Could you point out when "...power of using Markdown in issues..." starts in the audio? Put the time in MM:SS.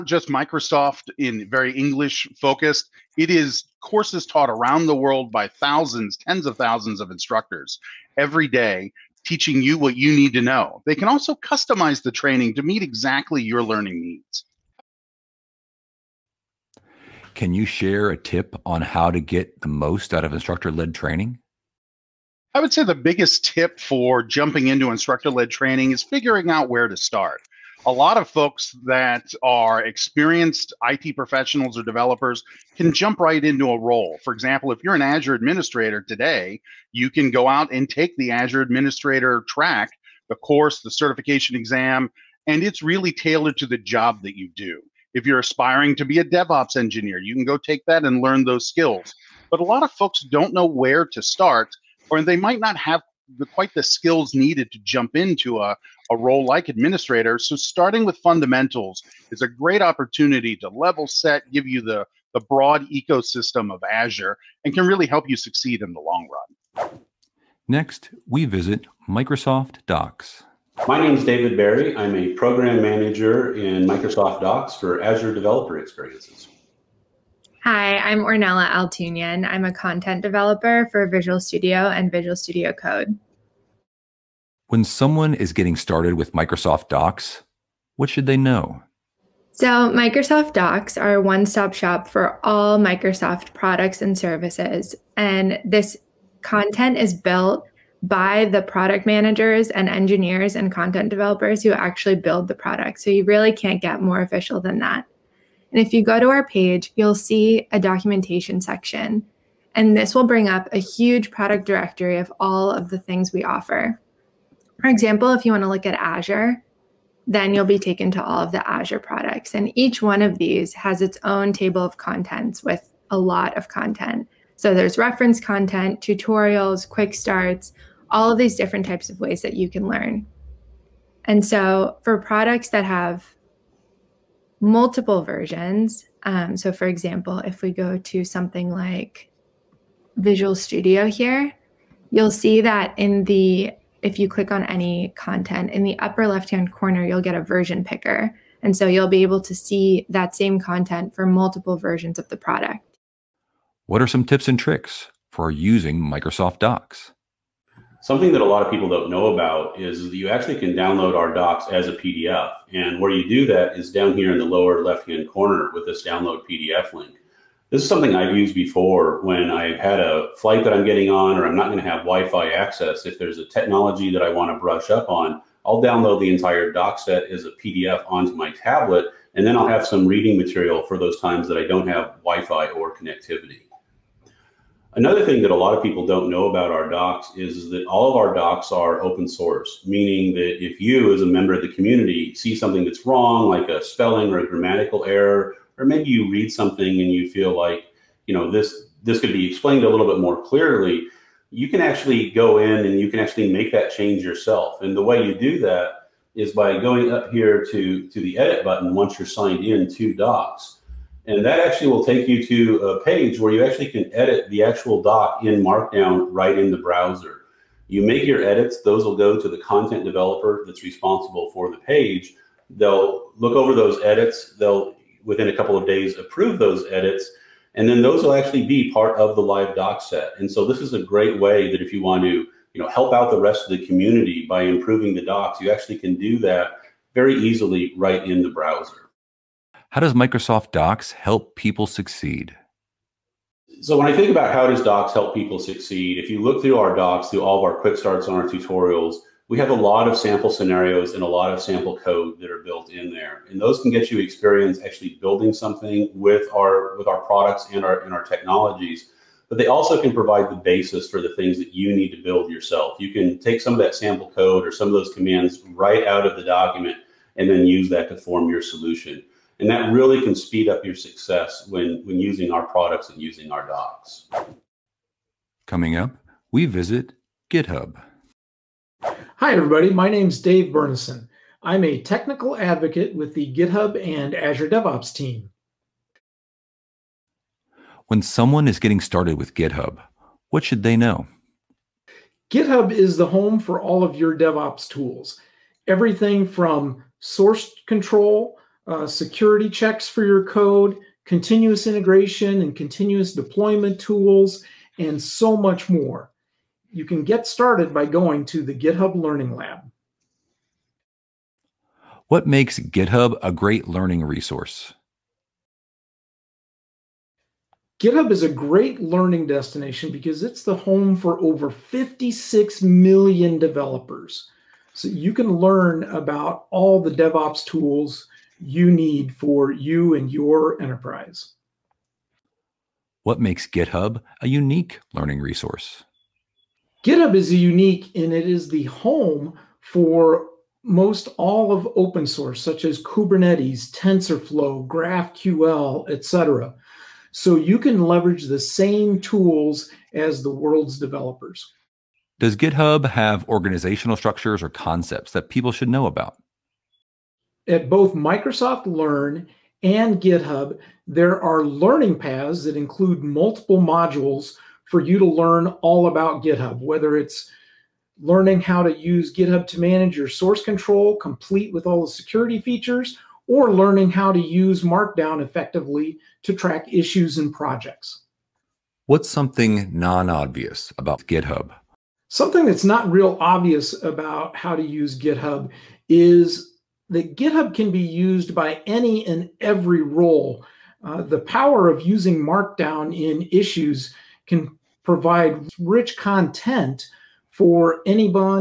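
06:31.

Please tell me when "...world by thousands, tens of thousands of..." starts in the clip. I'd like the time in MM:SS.
00:04.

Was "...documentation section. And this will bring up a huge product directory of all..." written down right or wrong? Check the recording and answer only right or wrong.
right.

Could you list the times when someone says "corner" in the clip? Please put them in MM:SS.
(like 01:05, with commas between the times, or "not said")
02:26, 02:45.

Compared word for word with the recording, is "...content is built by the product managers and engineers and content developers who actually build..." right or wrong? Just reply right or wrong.
right.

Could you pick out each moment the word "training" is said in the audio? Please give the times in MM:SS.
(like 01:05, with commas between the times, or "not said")
00:12, 00:20, 00:25.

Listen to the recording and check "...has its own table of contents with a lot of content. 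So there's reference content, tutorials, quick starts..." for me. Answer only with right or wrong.
right.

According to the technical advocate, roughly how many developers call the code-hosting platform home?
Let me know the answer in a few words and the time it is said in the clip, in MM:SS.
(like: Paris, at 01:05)
56 million, at 05:21.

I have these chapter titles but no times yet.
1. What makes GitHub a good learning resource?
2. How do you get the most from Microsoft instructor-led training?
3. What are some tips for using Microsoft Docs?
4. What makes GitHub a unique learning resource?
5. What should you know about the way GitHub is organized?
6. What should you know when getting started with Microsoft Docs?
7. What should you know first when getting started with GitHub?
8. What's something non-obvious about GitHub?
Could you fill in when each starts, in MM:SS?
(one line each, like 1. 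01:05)
1. 05:17
2. 00:23
3. 02:38
4. 05:37
5. 05:57
6. 01:29
7. 04:47
8. 06:22.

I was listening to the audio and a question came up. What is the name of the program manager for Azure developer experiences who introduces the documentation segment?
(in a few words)
David Barry.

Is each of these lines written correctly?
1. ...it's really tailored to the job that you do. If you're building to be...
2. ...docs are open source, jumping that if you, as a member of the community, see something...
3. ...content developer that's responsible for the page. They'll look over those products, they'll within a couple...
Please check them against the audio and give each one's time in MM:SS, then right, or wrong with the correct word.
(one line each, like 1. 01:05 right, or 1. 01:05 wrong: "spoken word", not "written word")
1. 00:42 wrong: "aspiring", not "building"
2. 03:08 wrong: "meaning", not "jumping"
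3. 03:39 wrong: "edits", not "products".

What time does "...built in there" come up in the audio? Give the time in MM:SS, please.
04:12.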